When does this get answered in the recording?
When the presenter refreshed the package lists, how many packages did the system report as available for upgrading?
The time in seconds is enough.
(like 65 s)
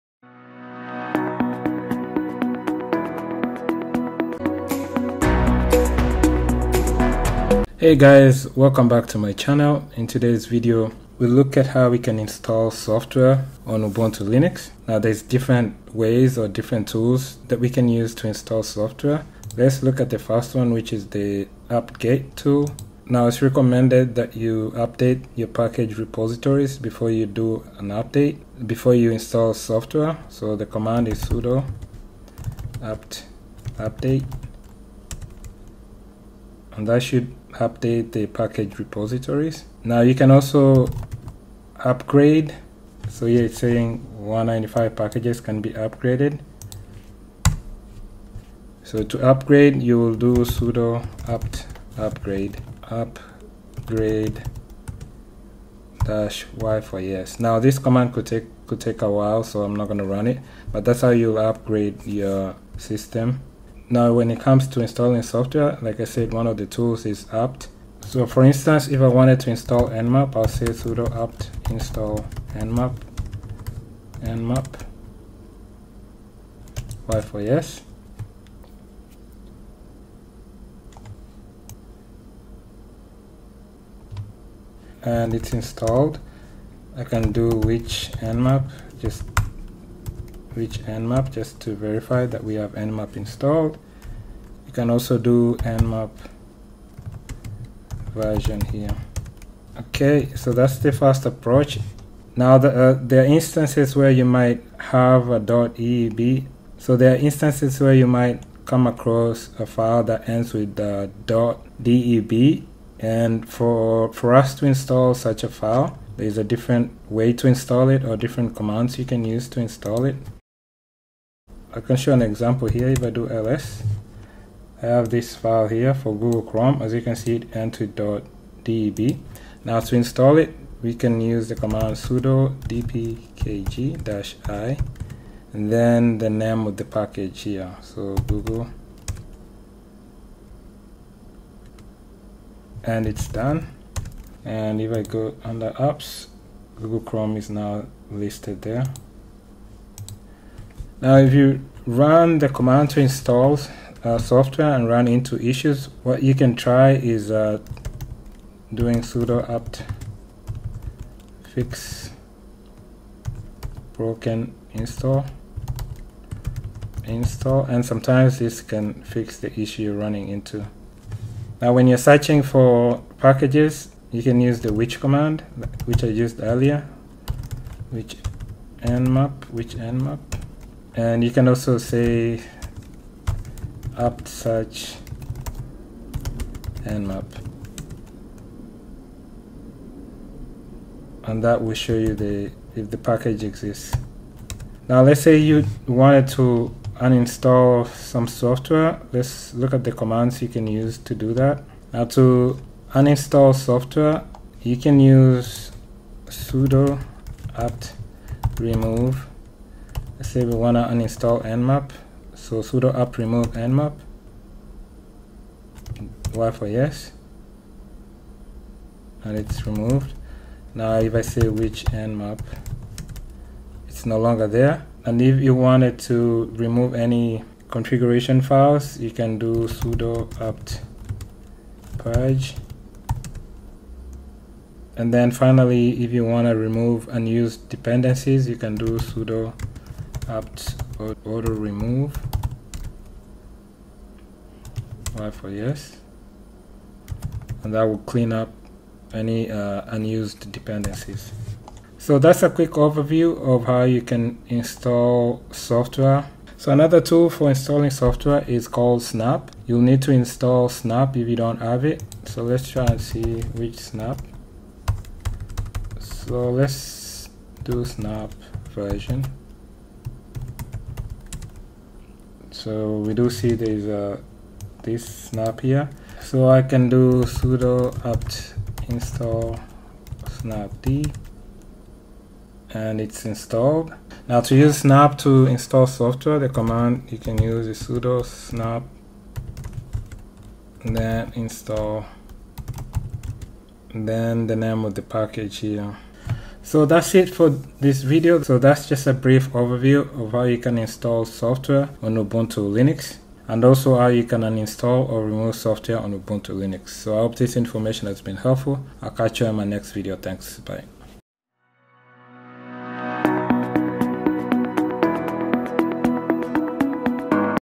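44 s.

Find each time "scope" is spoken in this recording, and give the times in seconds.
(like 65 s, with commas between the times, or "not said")
not said.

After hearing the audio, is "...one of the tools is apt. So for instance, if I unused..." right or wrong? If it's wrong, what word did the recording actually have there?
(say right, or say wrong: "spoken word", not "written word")
wrong: "wanted", not "unused".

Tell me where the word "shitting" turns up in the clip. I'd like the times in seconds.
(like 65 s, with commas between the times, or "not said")
not said.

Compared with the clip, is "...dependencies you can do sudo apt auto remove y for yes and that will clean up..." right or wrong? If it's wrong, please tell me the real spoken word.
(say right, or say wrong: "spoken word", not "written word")
right.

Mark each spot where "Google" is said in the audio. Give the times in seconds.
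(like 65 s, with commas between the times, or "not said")
126 s, 138 s, 146 s.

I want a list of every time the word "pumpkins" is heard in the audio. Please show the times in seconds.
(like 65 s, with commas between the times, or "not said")
not said.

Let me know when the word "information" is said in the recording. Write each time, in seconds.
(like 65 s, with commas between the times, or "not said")
307 s.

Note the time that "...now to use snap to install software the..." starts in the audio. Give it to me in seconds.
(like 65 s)
284 s.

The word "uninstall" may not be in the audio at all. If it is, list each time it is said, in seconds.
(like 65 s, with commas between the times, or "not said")
196 s, 202 s, 210 s, 304 s.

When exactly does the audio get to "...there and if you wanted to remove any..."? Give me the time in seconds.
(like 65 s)
224 s.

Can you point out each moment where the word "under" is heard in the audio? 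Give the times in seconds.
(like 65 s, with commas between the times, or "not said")
145 s.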